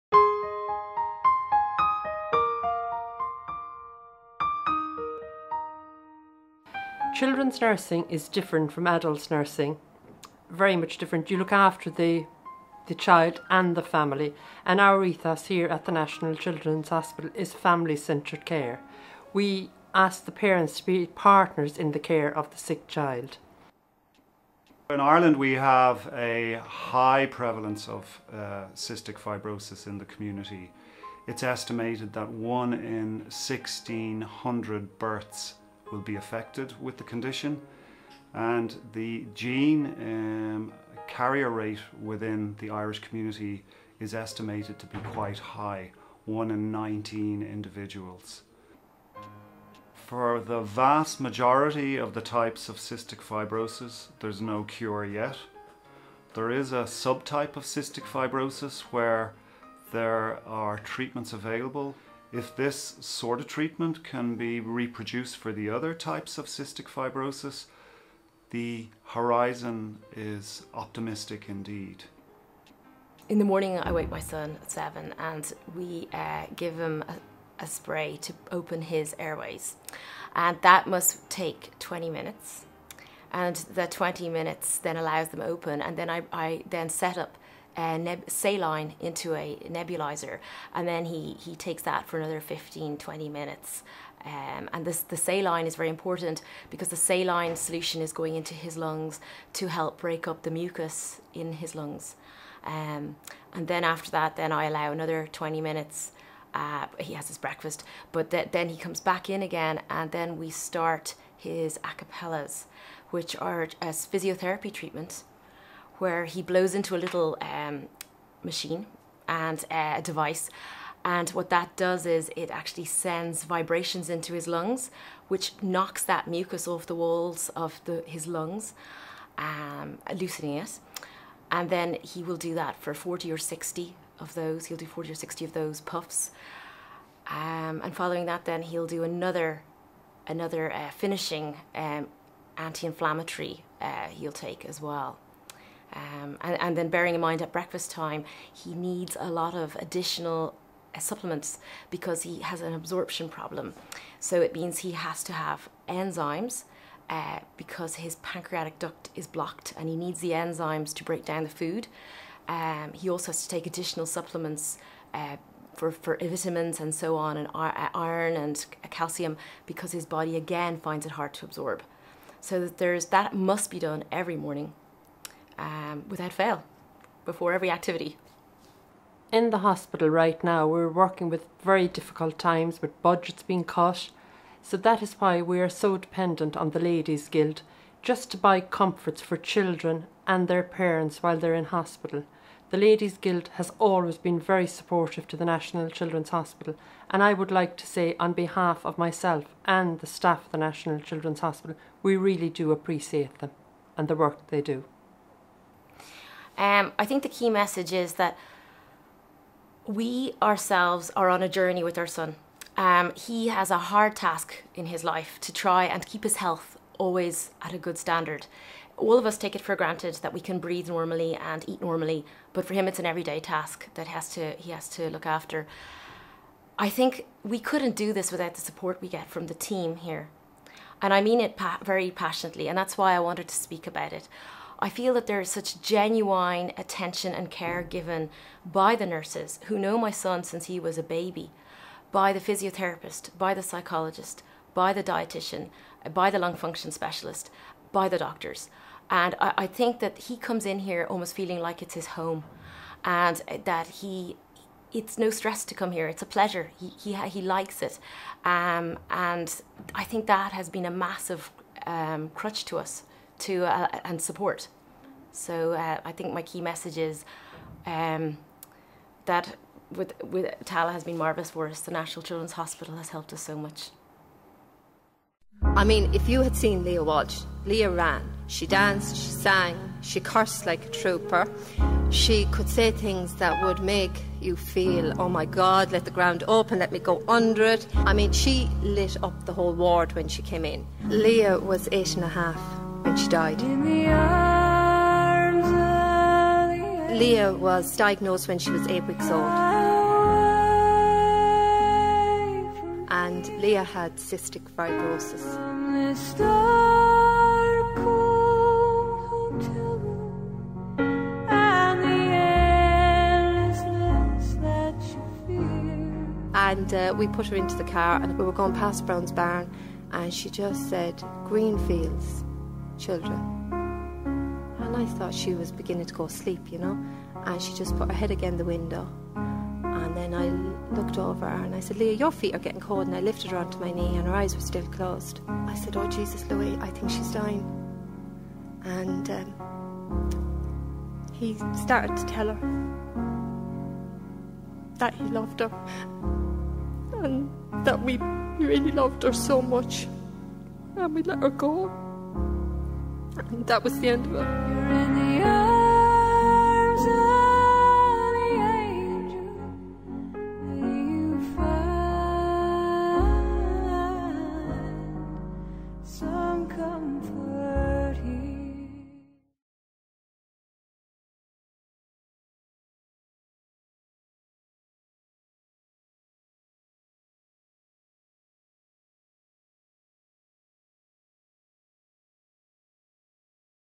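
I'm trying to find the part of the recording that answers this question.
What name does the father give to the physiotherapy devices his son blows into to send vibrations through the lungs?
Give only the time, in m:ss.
1:51.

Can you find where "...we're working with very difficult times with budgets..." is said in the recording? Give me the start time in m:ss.
3:00.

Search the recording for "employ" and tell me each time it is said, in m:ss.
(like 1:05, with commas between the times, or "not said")
not said.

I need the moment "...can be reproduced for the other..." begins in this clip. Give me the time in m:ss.
1:04.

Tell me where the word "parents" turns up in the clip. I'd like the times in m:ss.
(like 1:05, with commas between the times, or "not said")
0:20, 3:10.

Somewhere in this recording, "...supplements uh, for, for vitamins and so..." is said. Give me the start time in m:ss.
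2:44.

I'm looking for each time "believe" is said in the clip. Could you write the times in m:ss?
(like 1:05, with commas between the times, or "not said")
not said.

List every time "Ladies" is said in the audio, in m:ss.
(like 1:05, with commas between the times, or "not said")
3:06, 3:12.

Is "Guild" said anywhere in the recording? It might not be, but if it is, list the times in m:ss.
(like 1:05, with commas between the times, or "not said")
3:07, 3:13.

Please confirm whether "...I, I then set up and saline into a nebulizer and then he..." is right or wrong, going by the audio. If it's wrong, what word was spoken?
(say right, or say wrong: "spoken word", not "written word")
right.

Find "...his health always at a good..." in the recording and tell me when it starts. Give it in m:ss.
3:36.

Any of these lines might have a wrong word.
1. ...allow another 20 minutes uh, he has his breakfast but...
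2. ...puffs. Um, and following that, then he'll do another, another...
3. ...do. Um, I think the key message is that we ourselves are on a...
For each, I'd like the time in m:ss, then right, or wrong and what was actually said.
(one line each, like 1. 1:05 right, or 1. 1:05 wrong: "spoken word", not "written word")
1. 1:44 right
2. 2:15 right
3. 3:24 right.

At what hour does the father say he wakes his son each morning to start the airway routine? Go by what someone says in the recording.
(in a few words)
7.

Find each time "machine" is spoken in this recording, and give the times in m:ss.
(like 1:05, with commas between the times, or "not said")
1:58.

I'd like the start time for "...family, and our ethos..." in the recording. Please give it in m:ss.
0:13.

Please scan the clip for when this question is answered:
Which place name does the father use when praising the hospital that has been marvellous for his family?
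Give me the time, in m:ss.
4:30.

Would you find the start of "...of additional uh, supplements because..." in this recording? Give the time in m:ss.
2:29.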